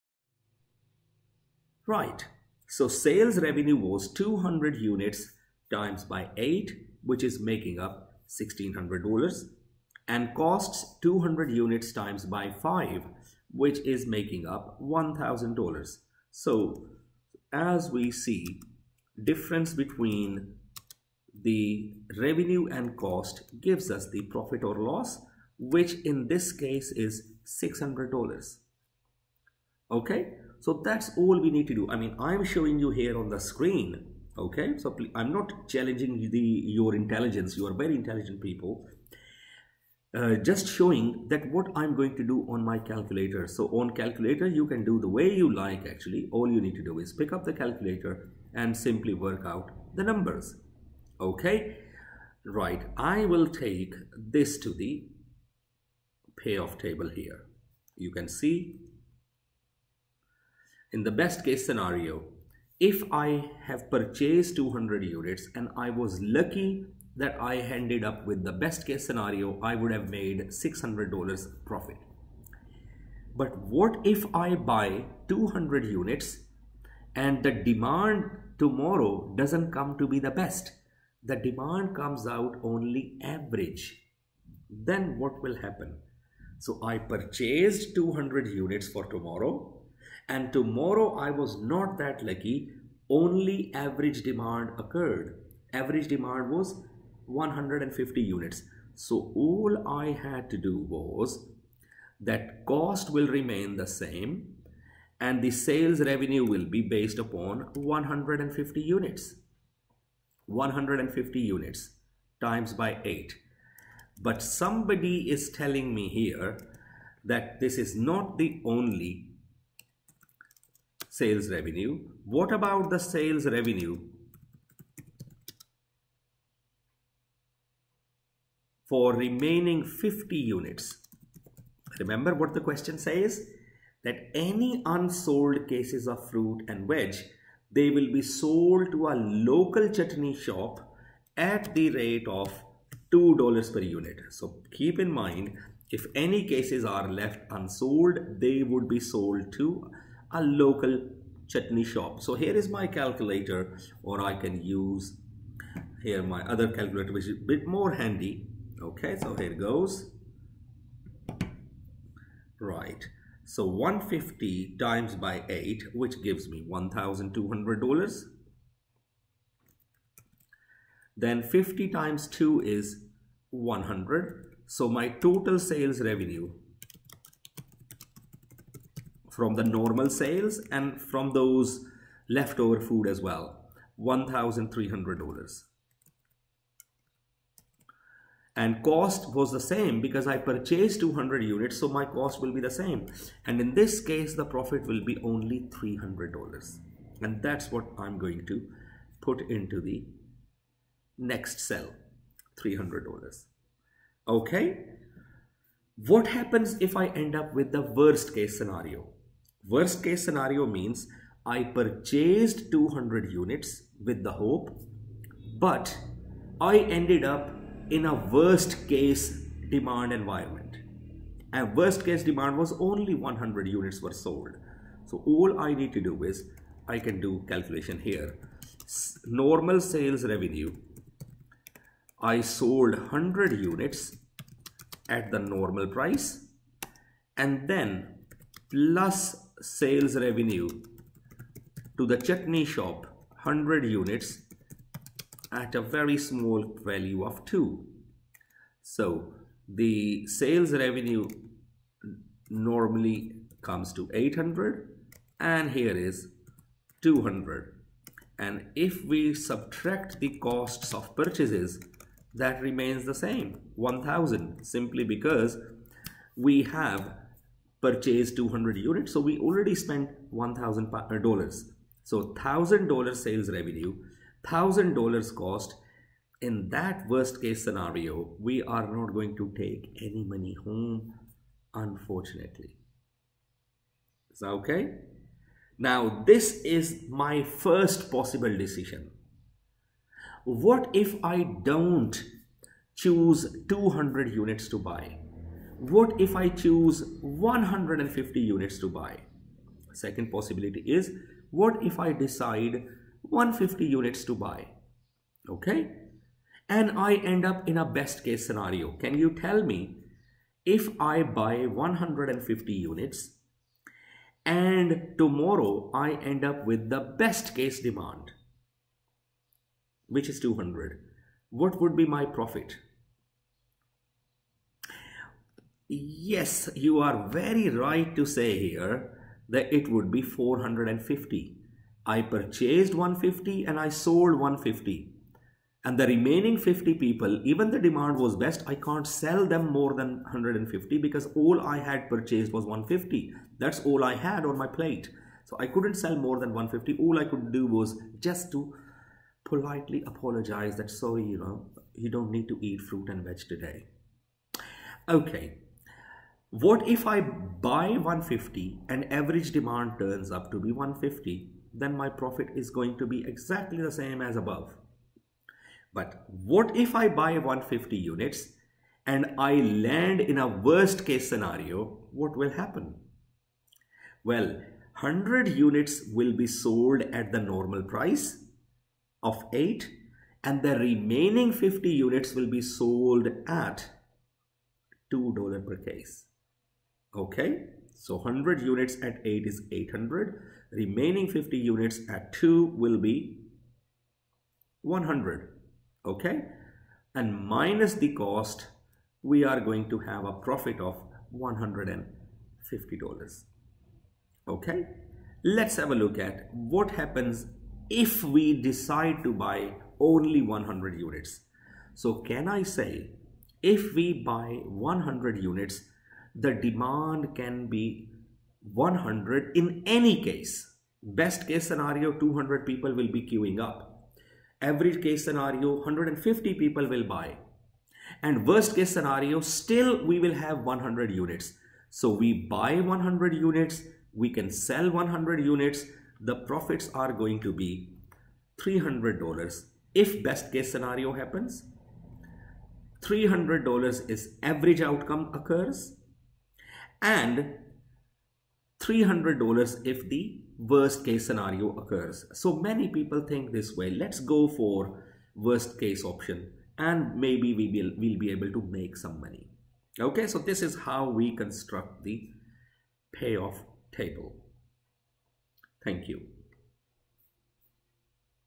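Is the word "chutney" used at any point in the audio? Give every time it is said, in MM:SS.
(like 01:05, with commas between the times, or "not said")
02:19, 02:31, 04:02.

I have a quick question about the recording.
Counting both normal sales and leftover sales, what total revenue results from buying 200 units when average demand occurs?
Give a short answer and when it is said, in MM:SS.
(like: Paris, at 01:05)
$1,300, at 03:03.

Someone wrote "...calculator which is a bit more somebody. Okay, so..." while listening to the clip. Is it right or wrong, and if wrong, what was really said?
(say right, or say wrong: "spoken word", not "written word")
wrong: "handy", not "somebody".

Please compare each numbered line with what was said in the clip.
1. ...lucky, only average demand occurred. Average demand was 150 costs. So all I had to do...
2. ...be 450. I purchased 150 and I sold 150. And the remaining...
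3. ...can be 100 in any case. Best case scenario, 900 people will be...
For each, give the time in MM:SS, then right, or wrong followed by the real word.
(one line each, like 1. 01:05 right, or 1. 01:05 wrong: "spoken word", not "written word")
1. 01:32 wrong: "units", not "costs"
2. 05:30 right
3. 06:57 wrong: "200", not "900".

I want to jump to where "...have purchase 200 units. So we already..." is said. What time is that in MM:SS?
04:26.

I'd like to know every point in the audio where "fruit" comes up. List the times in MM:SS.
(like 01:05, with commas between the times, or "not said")
02:16, 05:52.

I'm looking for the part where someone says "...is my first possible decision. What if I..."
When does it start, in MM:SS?
04:46.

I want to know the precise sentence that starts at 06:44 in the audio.
Okay, let's have a look at what happens if we decide to buy only 100 units.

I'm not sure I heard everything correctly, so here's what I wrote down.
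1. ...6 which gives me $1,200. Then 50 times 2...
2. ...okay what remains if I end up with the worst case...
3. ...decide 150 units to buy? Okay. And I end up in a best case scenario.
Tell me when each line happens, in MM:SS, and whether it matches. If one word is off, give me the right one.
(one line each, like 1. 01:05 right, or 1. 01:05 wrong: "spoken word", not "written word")
1. 02:45 wrong: "8", not "6"
2. 03:24 wrong: "happens", not "remains"
3. 05:02 right.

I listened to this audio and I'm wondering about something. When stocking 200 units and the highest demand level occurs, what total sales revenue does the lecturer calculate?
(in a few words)
$1,600.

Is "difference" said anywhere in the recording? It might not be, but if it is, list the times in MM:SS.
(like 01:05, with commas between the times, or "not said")
00:19.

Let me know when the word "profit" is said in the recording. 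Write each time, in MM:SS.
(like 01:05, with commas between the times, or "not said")
00:24, 01:11, 03:14, 05:22, 06:02, 06:40, 07:16.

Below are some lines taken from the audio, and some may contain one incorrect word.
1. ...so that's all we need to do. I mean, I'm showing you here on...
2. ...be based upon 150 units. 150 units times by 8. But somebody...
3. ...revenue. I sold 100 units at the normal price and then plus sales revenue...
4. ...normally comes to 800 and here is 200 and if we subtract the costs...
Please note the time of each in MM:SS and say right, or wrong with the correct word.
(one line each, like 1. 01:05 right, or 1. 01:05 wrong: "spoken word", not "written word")
1. 00:30 right
2. 01:46 right
3. 03:50 right
4. 04:12 right.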